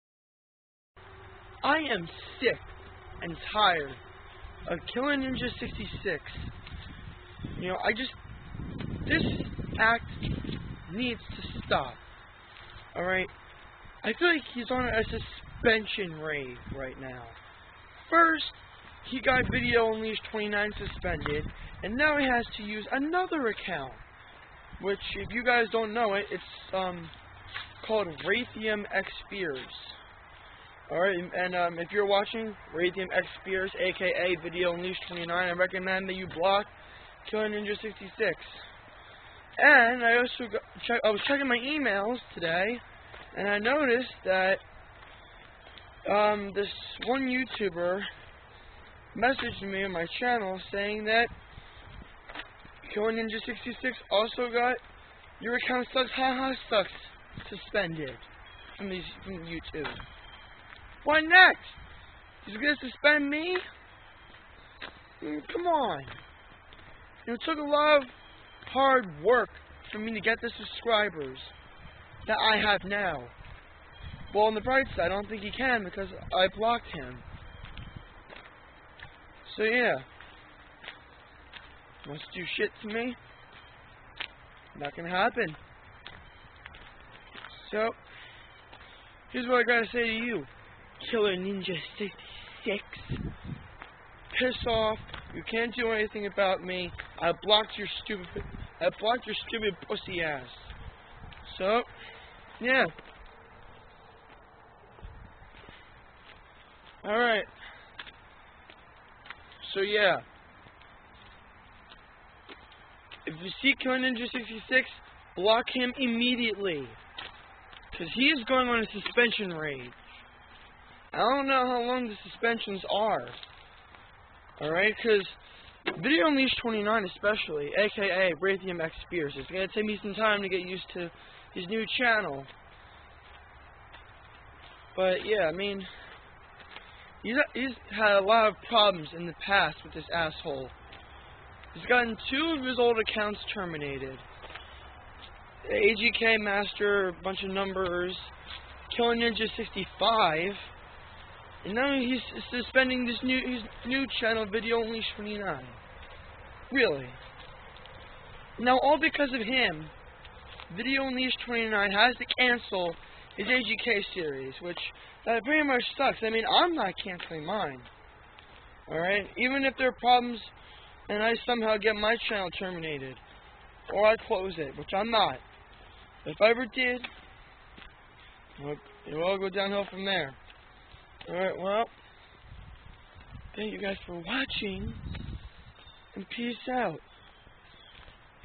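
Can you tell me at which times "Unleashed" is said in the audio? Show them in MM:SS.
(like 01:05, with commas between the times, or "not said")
00:19, 00:34, 02:06, 02:41.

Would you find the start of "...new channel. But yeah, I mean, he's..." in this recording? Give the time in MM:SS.
02:11.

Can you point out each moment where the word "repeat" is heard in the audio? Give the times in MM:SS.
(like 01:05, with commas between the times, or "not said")
not said.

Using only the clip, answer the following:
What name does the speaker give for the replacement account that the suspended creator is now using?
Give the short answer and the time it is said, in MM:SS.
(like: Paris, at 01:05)
Raytheum X, at 00:28.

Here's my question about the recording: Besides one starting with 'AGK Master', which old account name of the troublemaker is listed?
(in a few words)
Killing Ninja 65.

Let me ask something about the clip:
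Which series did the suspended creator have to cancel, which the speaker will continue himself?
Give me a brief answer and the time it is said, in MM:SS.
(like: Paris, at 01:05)
AGK series, at 02:43.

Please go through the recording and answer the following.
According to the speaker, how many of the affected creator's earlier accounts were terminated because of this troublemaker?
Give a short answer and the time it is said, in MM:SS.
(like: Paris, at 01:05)
2, at 02:22.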